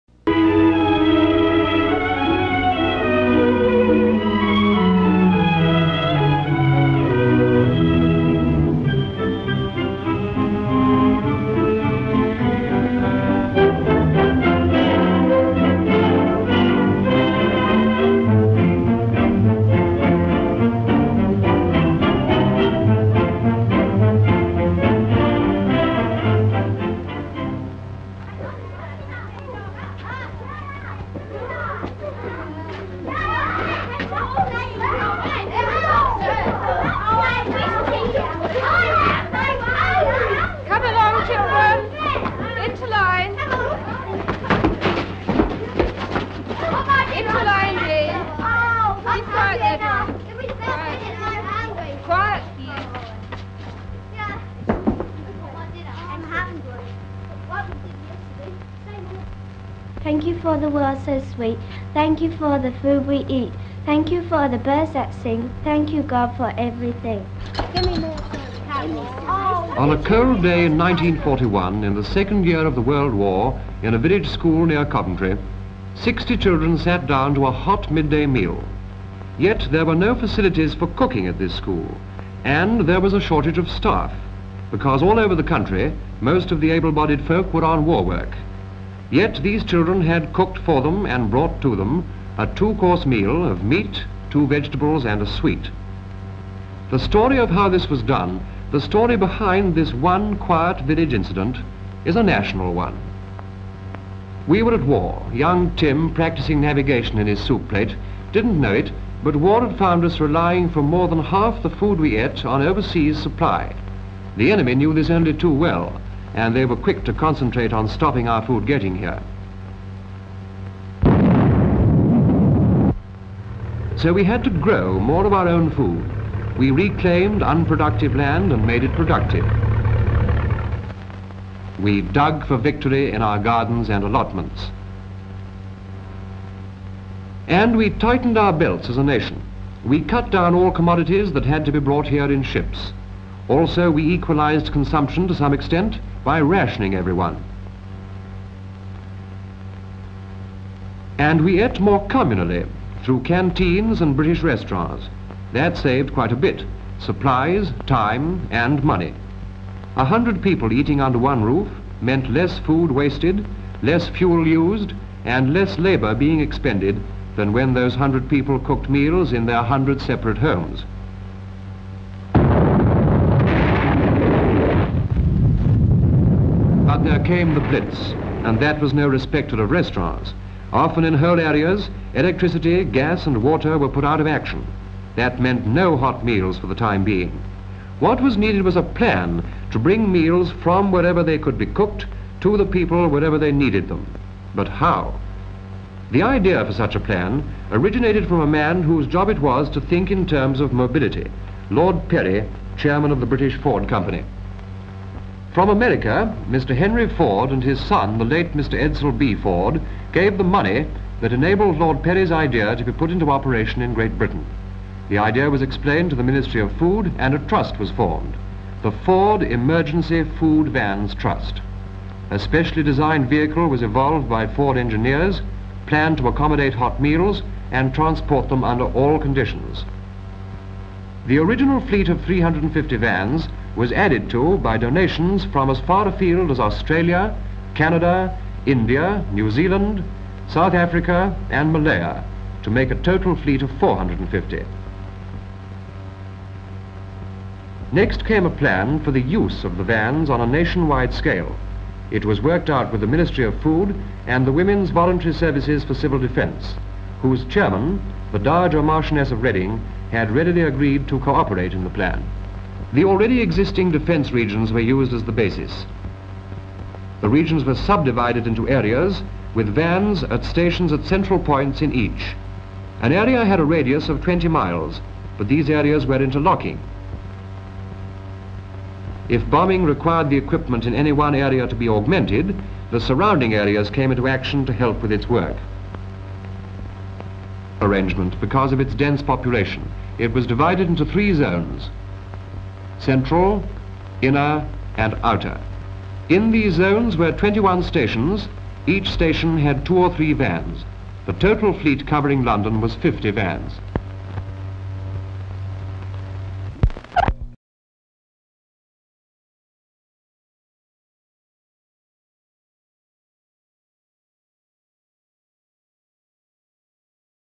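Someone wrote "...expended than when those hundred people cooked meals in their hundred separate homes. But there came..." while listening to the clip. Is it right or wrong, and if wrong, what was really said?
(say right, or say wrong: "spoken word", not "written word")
right.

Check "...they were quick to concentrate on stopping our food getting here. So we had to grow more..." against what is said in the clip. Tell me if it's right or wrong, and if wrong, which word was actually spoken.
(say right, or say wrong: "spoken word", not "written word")
right.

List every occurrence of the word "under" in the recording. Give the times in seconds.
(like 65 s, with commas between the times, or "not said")
161 s, 228 s.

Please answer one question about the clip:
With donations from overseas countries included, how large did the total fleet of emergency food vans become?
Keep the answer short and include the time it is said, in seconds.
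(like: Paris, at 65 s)
450, at 243 s.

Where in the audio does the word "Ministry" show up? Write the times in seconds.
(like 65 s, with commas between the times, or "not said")
216 s, 253 s.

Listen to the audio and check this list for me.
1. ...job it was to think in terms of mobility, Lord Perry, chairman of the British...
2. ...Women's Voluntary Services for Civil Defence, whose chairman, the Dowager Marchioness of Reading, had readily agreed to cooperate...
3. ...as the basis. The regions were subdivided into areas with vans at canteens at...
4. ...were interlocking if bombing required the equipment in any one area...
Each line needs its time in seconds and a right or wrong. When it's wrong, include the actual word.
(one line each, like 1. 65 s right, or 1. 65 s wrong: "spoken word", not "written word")
1. 199 s right
2. 254 s right
3. 265 s wrong: "stations", not "canteens"
4. 276 s right.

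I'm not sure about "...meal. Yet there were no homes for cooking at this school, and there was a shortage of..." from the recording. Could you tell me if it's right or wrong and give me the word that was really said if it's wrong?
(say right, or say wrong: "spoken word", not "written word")
wrong: "facilities", not "homes".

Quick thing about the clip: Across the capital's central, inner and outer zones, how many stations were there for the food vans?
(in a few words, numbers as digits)
21.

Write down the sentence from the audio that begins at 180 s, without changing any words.
Often in whole areas, electricity, gas and water were put out of action.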